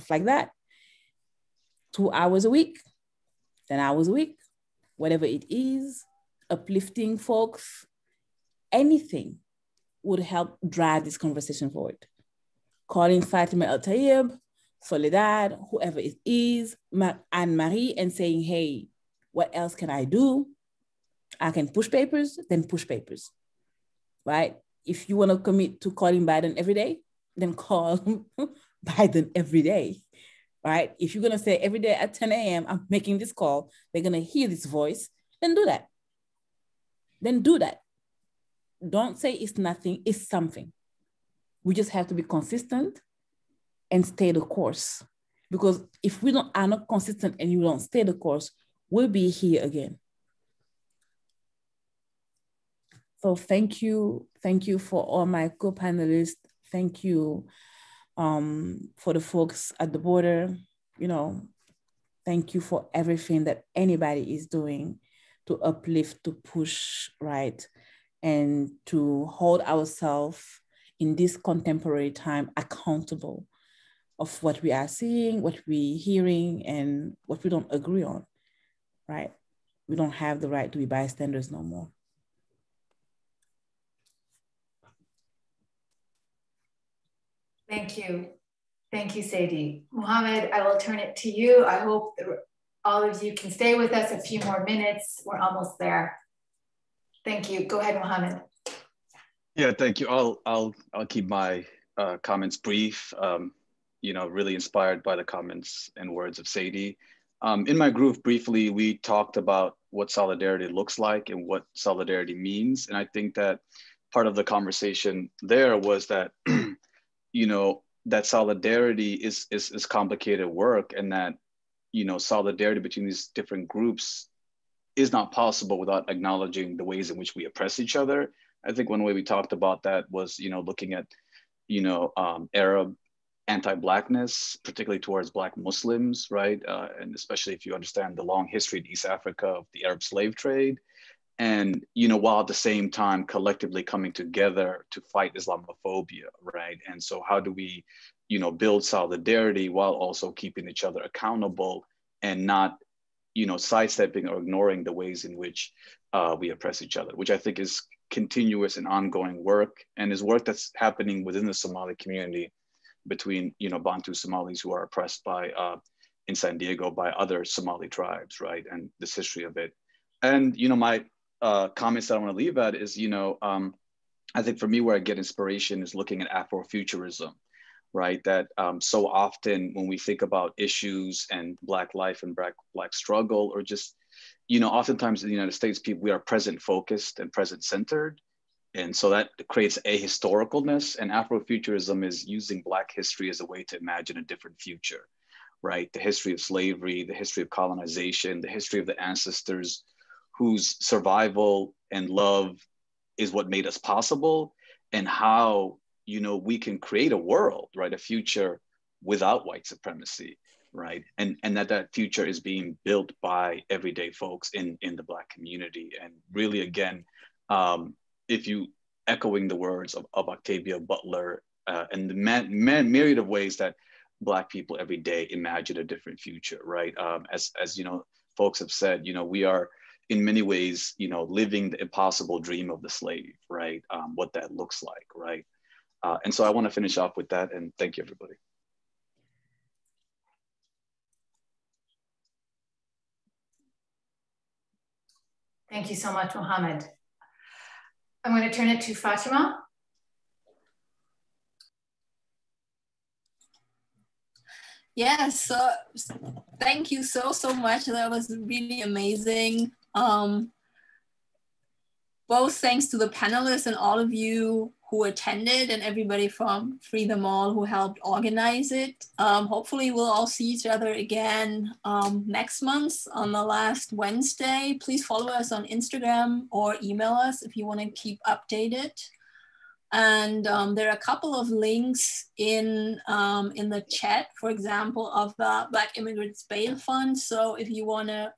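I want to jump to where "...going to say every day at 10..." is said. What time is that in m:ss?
0:31.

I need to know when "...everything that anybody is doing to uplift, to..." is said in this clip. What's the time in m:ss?
1:02.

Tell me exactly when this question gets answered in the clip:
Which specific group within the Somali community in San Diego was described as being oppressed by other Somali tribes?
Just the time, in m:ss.
2:43.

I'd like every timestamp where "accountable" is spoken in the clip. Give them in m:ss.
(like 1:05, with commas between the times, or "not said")
1:12, 2:31.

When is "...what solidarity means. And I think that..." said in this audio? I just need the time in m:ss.
1:51.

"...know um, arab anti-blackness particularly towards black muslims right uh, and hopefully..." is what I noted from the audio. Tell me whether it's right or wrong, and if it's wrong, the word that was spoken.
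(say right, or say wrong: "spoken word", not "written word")
wrong: "especially", not "hopefully".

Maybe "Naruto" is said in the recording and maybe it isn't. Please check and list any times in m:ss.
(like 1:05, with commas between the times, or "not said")
not said.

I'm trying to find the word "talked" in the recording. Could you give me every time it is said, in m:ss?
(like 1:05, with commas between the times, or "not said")
1:48, 2:09.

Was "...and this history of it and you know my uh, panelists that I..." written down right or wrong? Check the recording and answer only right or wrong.
wrong.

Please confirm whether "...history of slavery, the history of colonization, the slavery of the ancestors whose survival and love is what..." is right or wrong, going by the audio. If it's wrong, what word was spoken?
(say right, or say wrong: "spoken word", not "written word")
wrong: "history", not "slavery".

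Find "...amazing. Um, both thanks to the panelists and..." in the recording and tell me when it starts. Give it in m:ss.
4:18.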